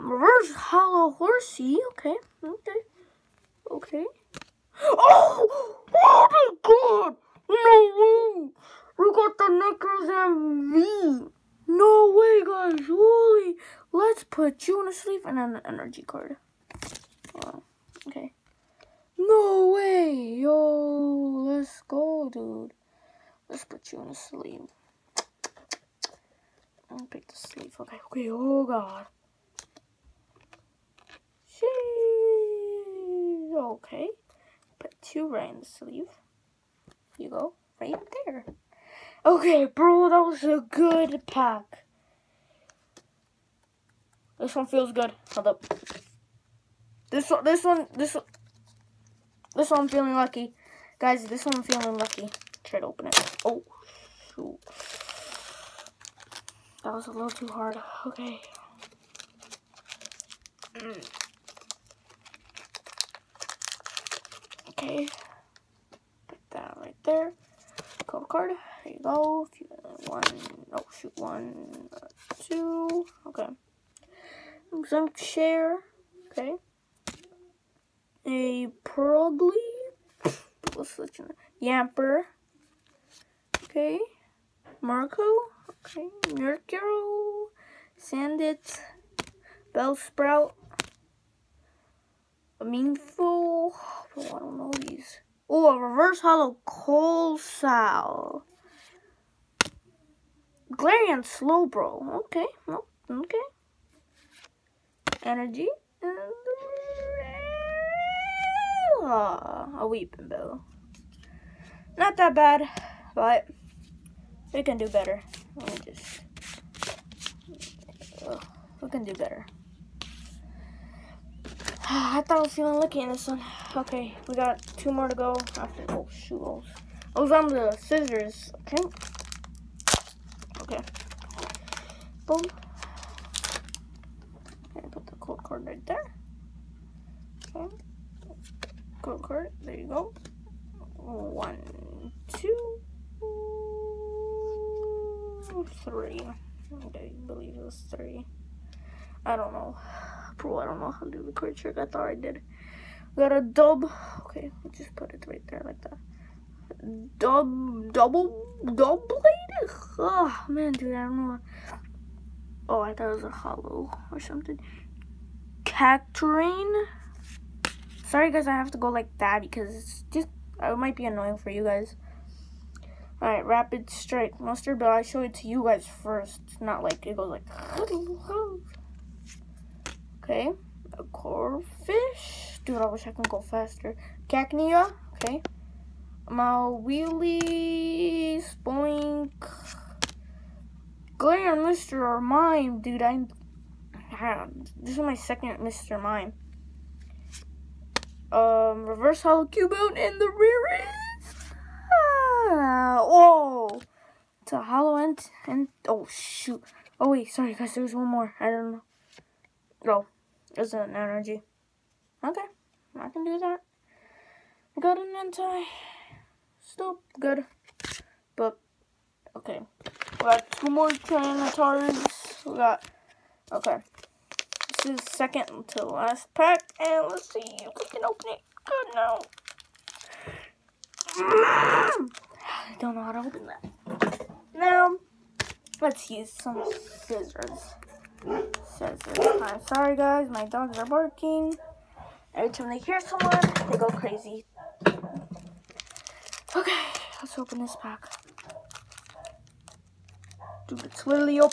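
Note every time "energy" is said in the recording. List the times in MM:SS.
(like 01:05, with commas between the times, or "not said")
00:15, 01:45, 03:30.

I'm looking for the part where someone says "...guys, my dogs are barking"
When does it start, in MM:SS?
03:59.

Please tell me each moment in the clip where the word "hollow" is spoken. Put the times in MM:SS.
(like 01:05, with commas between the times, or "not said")
00:00, 01:36, 02:43, 03:19, 03:24.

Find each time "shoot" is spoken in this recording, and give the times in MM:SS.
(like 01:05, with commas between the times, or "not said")
00:54, 01:10, 02:06, 03:26.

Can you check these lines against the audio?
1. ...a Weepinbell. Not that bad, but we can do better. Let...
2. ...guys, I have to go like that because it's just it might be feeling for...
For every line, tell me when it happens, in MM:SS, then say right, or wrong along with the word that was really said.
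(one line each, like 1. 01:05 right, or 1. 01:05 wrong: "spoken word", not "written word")
1. 01:49 right
2. 02:48 wrong: "annoying", not "feeling".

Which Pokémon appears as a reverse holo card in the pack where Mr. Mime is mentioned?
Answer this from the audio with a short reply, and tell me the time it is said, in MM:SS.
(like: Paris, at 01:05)
Cubone, at 03:19.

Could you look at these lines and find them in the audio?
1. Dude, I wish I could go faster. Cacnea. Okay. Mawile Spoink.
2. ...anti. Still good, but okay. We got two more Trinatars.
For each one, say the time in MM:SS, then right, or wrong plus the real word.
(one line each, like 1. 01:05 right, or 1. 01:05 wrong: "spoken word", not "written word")
1. 03:02 right
2. 03:35 right.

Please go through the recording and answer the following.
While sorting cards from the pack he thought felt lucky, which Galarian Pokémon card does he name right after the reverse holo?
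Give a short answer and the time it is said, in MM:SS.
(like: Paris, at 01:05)
Galarian Slowbro, at 01:40.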